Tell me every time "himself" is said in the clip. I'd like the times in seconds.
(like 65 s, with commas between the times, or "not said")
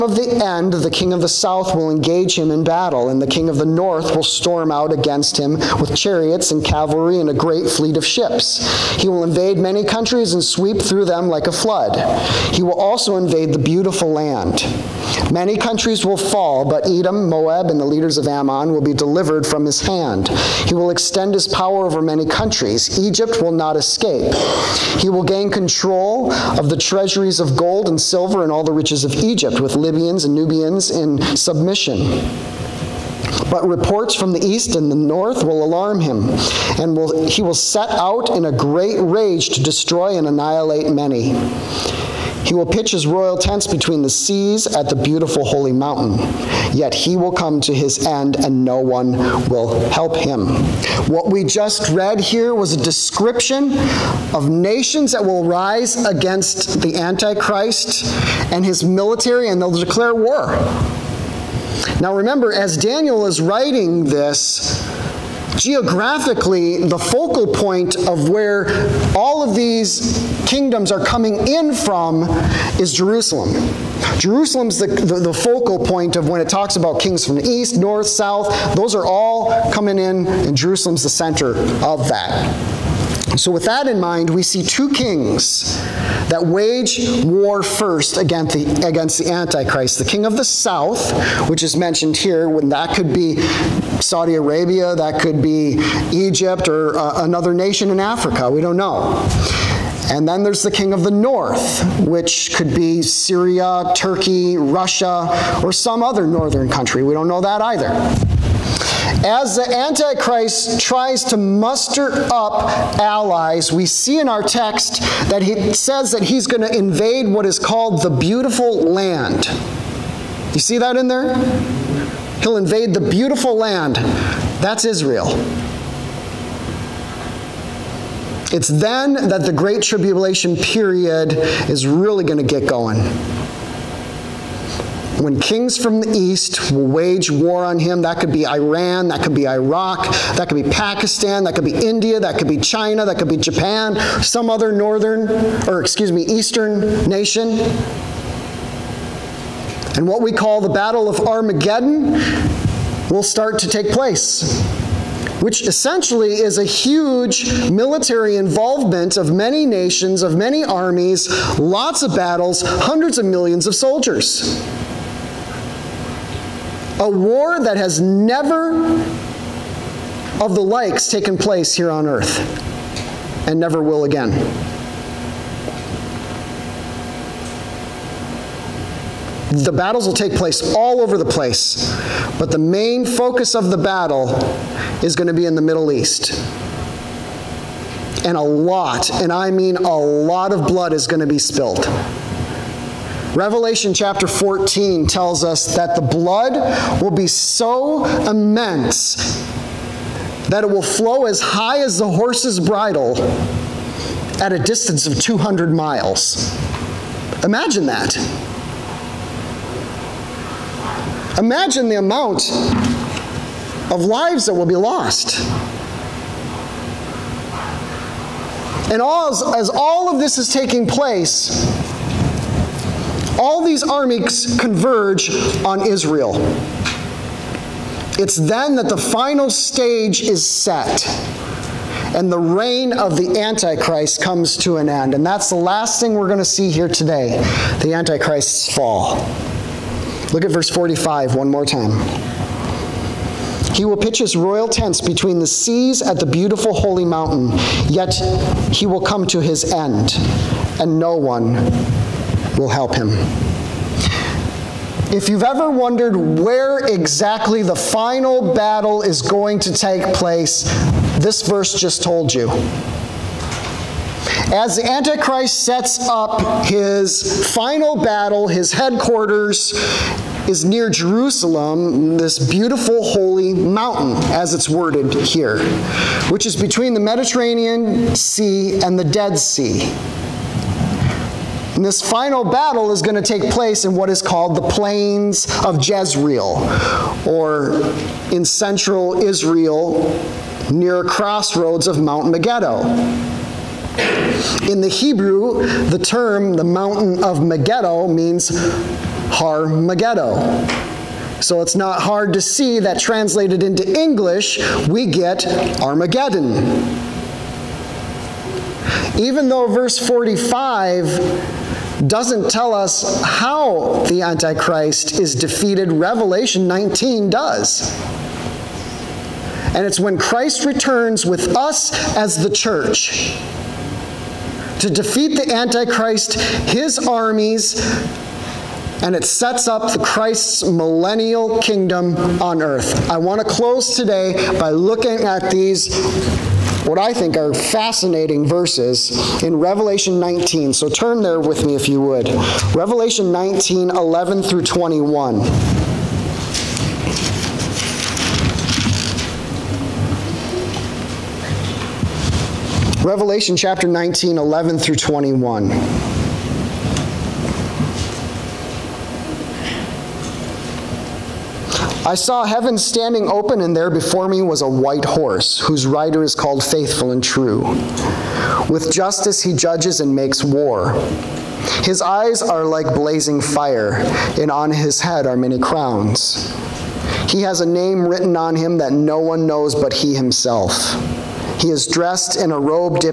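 380 s.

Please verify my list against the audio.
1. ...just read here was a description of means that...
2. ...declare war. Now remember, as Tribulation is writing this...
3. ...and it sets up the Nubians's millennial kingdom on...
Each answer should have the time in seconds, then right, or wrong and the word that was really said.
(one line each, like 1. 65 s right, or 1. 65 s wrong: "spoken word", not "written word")
1. 51 s wrong: "nations", not "means"
2. 59 s wrong: "Daniel", not "Tribulation"
3. 329 s wrong: "Christ", not "Nubians".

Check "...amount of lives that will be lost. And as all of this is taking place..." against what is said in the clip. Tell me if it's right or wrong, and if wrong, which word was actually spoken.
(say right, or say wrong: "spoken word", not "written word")
right.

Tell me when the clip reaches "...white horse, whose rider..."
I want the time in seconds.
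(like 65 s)
364 s.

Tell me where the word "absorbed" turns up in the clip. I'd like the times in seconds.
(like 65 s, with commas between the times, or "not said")
not said.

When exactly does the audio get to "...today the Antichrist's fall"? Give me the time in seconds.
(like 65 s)
236 s.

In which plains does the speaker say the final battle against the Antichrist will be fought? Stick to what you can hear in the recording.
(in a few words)
Plains of Jezreel.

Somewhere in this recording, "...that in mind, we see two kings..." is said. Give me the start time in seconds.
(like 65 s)
83 s.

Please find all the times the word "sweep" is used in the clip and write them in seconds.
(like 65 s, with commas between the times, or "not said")
10 s.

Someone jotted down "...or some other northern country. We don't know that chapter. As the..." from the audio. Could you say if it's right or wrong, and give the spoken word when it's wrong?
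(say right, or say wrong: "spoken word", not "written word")
wrong: "either", not "chapter".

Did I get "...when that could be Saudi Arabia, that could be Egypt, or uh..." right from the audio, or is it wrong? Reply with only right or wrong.
right.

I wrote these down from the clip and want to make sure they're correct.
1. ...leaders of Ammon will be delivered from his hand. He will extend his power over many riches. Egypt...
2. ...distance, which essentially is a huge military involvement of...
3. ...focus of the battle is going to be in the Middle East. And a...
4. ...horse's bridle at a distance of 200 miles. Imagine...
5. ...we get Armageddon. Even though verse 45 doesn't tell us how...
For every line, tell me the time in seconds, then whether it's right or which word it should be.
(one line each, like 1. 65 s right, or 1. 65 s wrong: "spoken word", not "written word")
1. 17 s wrong: "countries", not "riches"
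2. 153 s wrong: "place", not "distance"
3. 183 s right
4. 202 s right
5. 304 s right.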